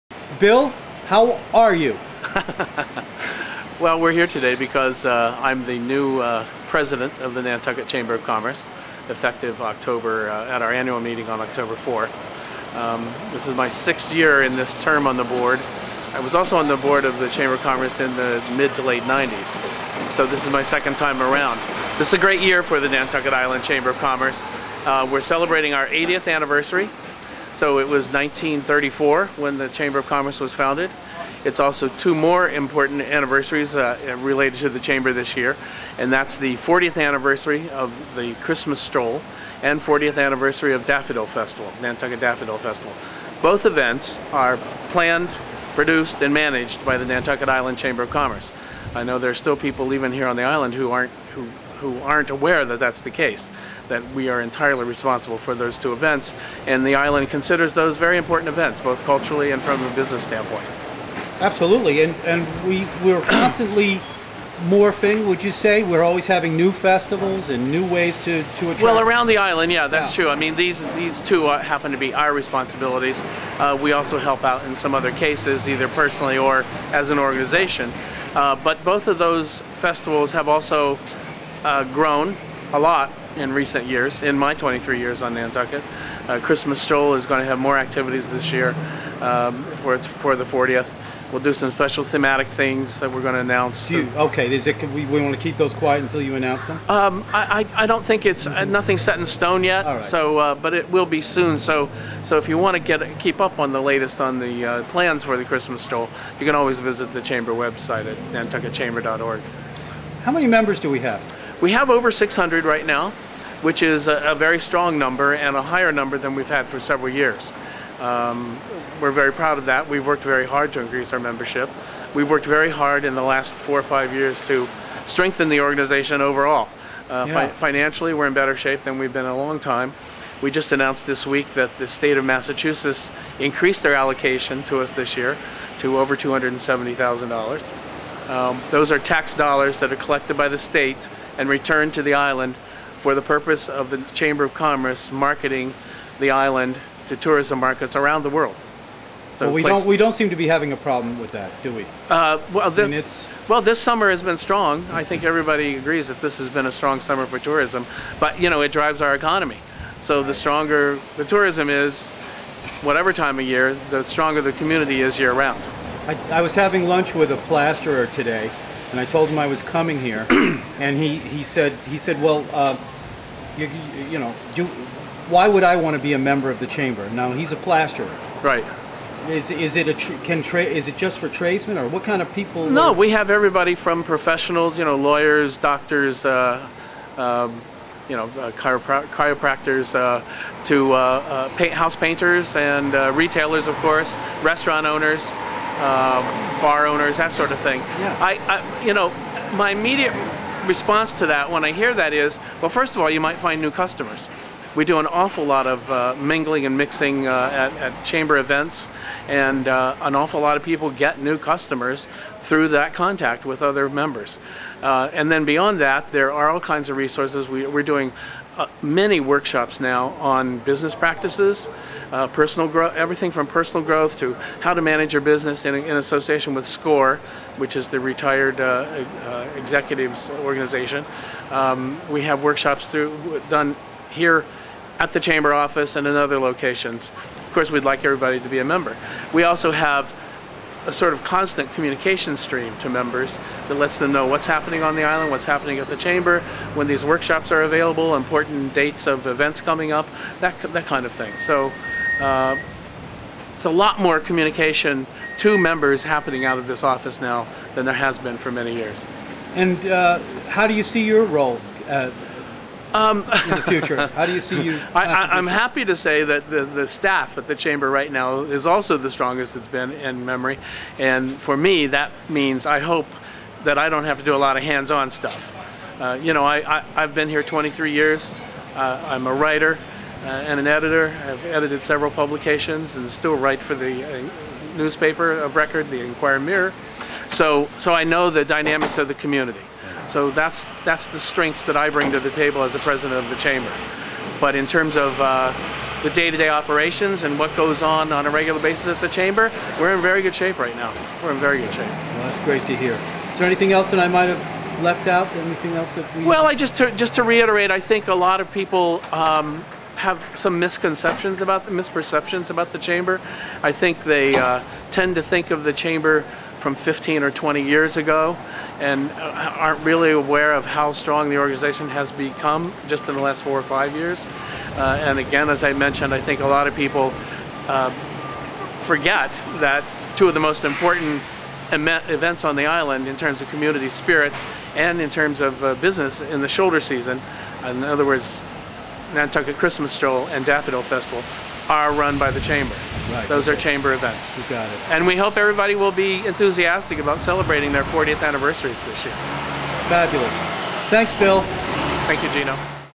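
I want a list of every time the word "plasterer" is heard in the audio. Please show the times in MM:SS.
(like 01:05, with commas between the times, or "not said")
02:47, 02:57.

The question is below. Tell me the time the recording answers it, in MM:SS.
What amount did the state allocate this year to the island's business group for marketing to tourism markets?
02:15.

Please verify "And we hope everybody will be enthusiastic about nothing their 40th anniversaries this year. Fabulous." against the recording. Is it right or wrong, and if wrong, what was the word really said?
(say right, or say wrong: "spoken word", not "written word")
wrong: "celebrating", not "nothing".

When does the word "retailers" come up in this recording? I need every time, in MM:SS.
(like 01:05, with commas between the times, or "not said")
03:13.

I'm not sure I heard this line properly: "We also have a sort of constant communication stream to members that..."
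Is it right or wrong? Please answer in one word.
right.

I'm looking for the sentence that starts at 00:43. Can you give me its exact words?
Both events are planned, produced, and managed by the Nantucket Island Chamber of Commerce.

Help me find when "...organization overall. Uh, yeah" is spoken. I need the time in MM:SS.
02:05.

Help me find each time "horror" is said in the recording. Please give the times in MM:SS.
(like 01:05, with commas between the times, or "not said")
not said.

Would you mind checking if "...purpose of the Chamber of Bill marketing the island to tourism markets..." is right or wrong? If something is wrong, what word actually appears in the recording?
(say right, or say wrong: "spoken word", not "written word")
wrong: "Commerce", not "Bill".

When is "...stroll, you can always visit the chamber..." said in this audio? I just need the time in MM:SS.
01:45.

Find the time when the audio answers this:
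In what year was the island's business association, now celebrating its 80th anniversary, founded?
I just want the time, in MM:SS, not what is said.
00:28.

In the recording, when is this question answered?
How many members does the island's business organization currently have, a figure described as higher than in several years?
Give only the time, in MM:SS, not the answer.
01:51.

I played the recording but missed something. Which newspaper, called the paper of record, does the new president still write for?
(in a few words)
Inquirer Mirror.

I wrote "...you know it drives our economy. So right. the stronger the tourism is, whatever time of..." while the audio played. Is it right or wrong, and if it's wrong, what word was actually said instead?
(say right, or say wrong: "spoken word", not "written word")
right.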